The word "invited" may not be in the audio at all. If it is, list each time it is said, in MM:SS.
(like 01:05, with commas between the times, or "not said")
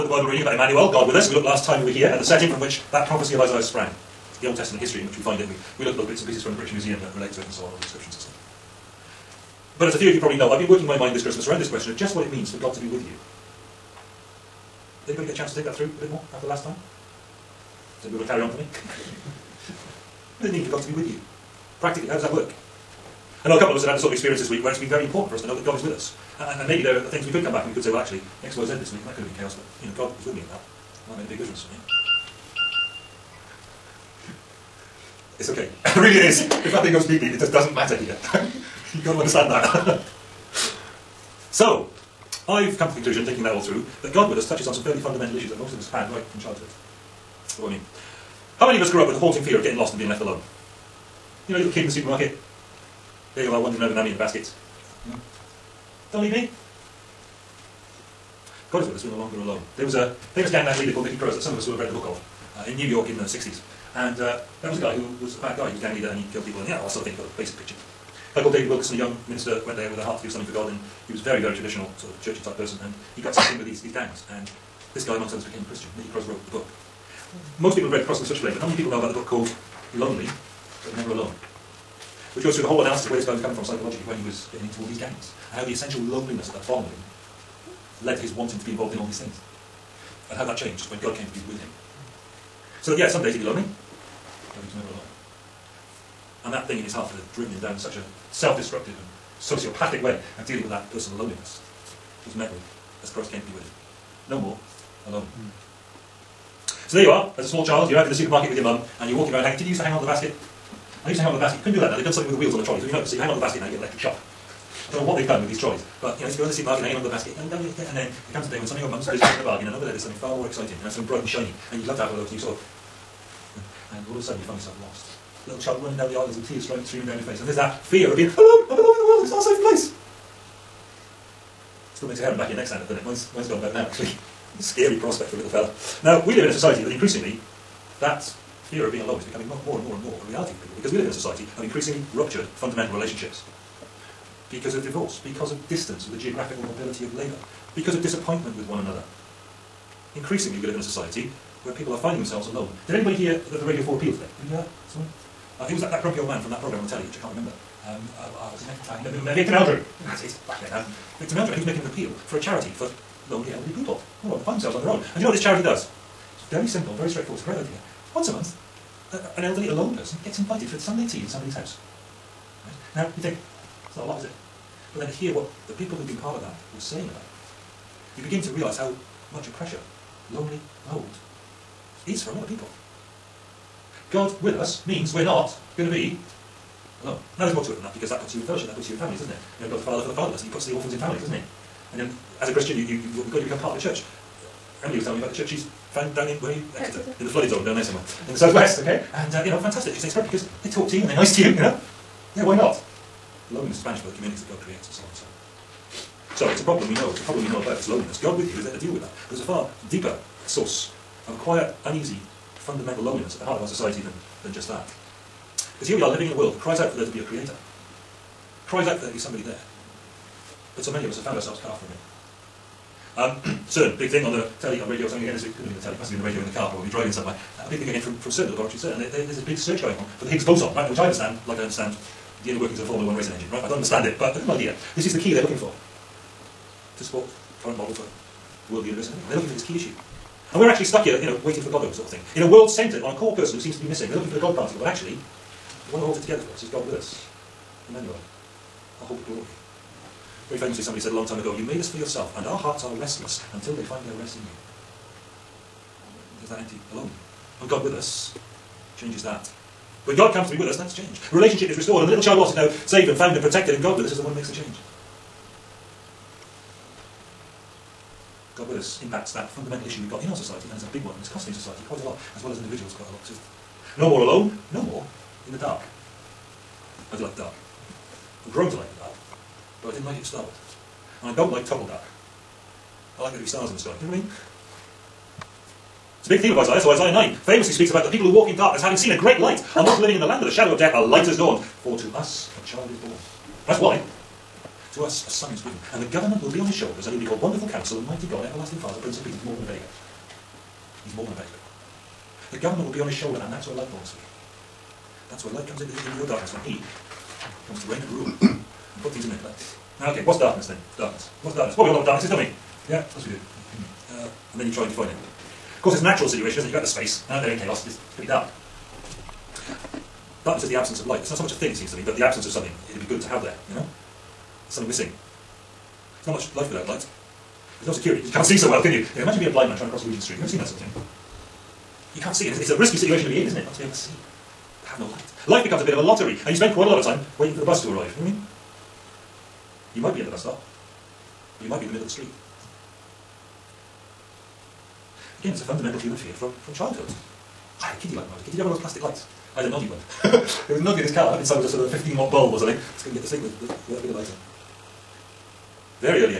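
02:50.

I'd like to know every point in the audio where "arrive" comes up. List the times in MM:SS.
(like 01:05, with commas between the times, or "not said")
05:37.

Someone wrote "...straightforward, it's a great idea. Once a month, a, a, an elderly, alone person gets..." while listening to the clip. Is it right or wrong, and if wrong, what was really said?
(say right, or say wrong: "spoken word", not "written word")
right.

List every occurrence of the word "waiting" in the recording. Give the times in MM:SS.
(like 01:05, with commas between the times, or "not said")
04:01, 05:37.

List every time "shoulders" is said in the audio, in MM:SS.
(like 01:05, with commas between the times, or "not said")
04:56, 05:03.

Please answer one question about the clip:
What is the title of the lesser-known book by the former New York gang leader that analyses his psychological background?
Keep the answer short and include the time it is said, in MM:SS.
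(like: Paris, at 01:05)
Lonely, but Never Alone, at 01:19.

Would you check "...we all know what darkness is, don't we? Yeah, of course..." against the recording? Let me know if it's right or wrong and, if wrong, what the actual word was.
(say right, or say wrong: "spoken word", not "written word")
right.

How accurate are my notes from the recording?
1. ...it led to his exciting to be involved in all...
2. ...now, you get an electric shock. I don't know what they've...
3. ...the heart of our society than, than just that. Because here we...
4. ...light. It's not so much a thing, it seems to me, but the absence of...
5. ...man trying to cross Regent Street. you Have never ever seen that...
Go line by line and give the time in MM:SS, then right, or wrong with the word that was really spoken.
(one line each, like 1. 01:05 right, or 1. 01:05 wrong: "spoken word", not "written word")
1. 01:26 wrong: "wanting", not "exciting"
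2. 01:53 right
3. 03:33 right
4. 05:21 right
5. 05:29 right.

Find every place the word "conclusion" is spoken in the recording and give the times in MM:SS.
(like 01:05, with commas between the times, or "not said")
00:42.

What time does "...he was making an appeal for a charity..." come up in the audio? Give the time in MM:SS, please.
02:41.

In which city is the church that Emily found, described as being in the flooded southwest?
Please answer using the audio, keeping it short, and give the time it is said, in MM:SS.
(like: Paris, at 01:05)
Exeter, at 03:16.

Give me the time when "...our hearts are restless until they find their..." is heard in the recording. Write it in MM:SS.
04:12.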